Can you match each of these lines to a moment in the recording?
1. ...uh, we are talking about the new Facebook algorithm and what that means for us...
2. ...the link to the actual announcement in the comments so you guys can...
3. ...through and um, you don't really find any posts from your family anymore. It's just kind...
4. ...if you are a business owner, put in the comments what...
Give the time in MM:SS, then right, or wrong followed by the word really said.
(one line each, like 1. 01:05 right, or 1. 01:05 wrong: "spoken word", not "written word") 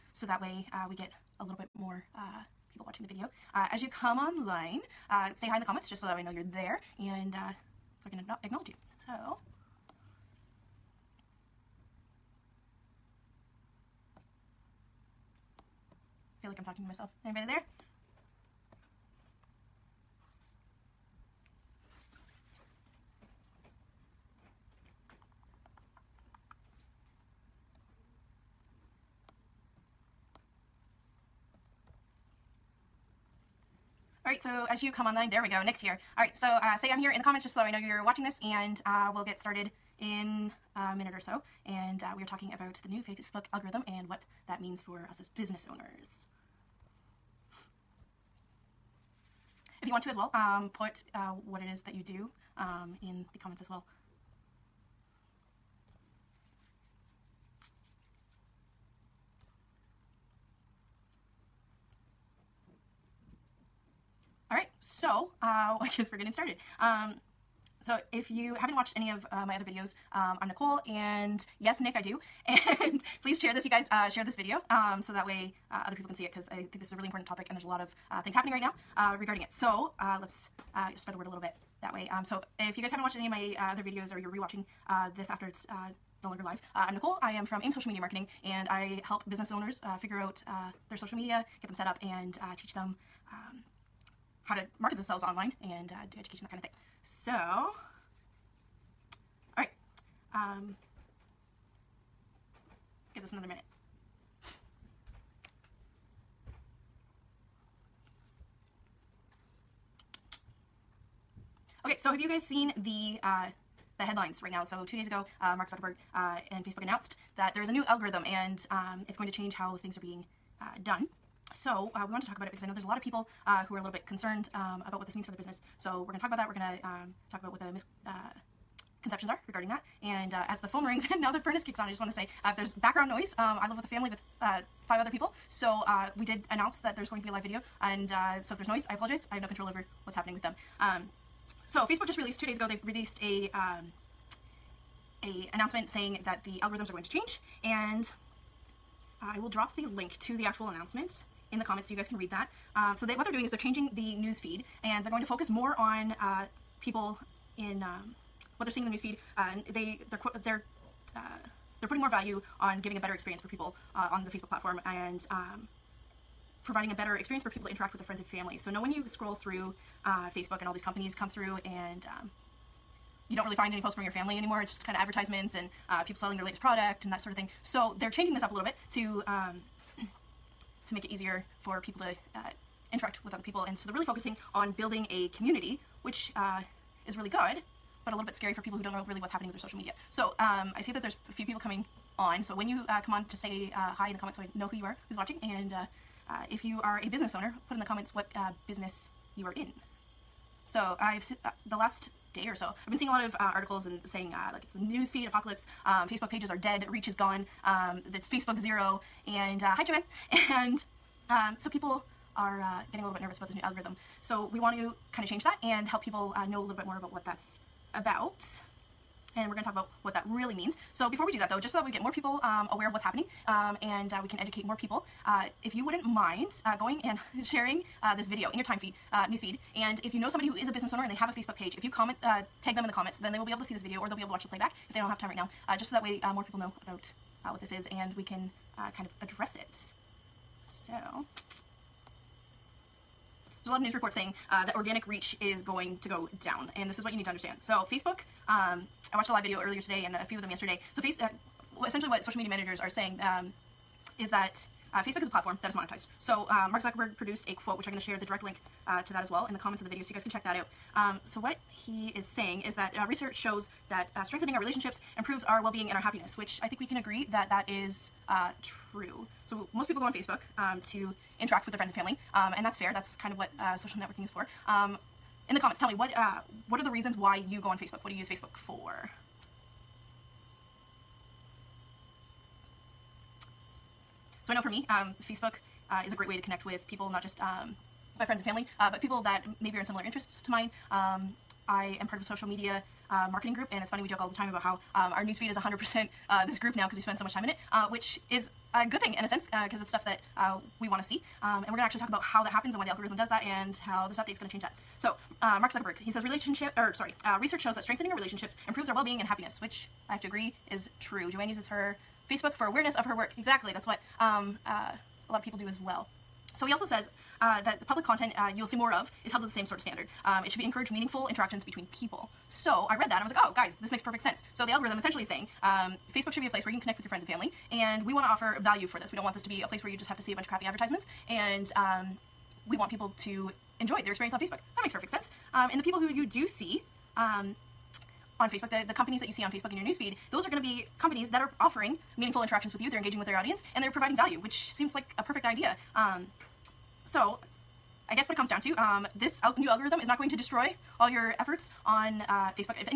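1. 00:42 right
2. 02:29 right
3. 02:51 right
4. 03:16 right.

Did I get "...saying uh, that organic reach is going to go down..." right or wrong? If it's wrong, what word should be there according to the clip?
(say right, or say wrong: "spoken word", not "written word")
right.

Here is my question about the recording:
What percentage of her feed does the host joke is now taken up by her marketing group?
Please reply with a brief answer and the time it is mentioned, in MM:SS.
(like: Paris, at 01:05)
100%, at 04:55.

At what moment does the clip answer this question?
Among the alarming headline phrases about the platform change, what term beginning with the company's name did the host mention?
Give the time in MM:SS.
03:28.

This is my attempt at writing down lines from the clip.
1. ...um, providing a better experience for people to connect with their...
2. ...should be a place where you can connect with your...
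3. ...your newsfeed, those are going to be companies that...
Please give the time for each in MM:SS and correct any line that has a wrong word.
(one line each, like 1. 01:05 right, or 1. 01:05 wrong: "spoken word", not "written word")
1. 02:45 wrong: "interact", not "connect"
2. 05:26 right
3. 05:39 right.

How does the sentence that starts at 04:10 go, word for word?
So, face, uh, essentially, what social media managers are saying um, is that uh, Facebook is a platform that is monetized.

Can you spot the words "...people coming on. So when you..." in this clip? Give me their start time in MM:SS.
03:11.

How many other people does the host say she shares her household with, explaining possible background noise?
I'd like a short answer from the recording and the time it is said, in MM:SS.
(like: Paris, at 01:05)
5, at 02:14.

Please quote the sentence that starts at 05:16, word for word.
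So he also says uh, that the public content uh, you'll see more of is held to the same sort of standard.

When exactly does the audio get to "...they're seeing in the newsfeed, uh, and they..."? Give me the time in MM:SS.
02:38.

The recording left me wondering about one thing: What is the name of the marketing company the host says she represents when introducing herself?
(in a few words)
AIM Social Media Marketing.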